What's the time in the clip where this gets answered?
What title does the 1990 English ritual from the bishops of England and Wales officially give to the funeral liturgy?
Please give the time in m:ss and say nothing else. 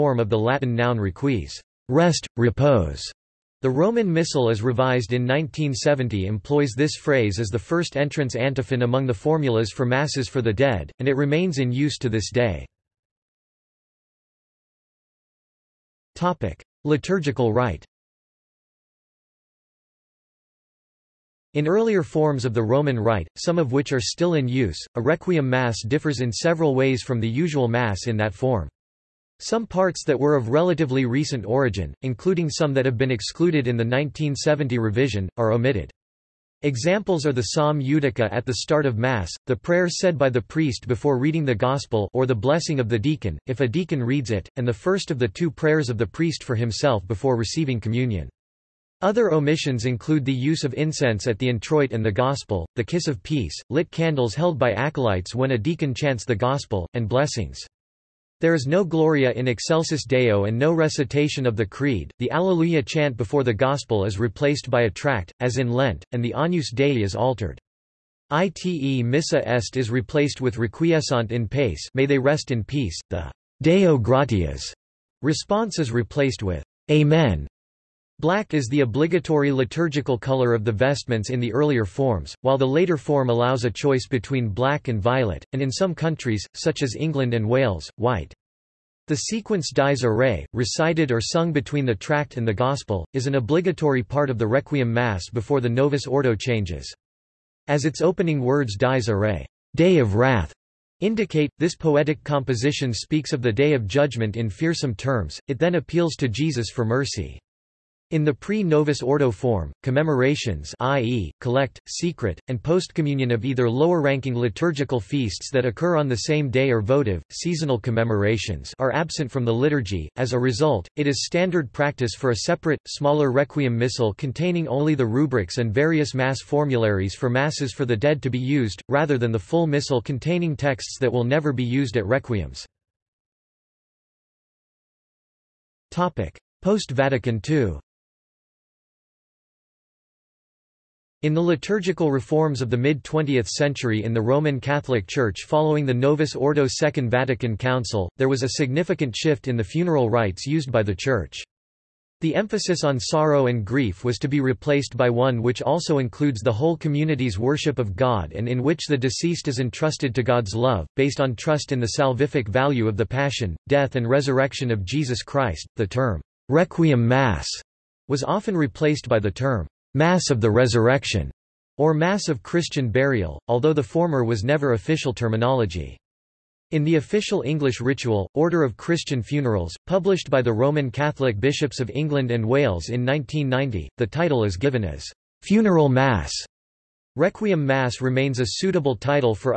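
3:05.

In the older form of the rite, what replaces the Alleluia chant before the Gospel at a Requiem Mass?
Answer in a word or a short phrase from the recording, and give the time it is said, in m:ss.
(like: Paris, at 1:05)
A tract, at 1:04.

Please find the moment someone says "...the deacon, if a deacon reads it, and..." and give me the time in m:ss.
0:42.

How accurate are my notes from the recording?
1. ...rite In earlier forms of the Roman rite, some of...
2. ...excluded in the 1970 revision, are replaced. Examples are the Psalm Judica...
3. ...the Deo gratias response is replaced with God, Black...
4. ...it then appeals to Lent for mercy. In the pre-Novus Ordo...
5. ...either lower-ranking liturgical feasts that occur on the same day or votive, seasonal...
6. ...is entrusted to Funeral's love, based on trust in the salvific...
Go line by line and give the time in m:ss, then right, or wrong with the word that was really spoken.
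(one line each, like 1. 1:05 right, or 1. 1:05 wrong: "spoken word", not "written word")
1. 0:17 right
2. 0:33 wrong: "omitted", not "replaced"
3. 1:13 wrong: "Amen", not "God"
4. 1:45 wrong: "Jesus", not "Lent"
5. 1:53 right
6. 2:39 wrong: "God", not "Funeral".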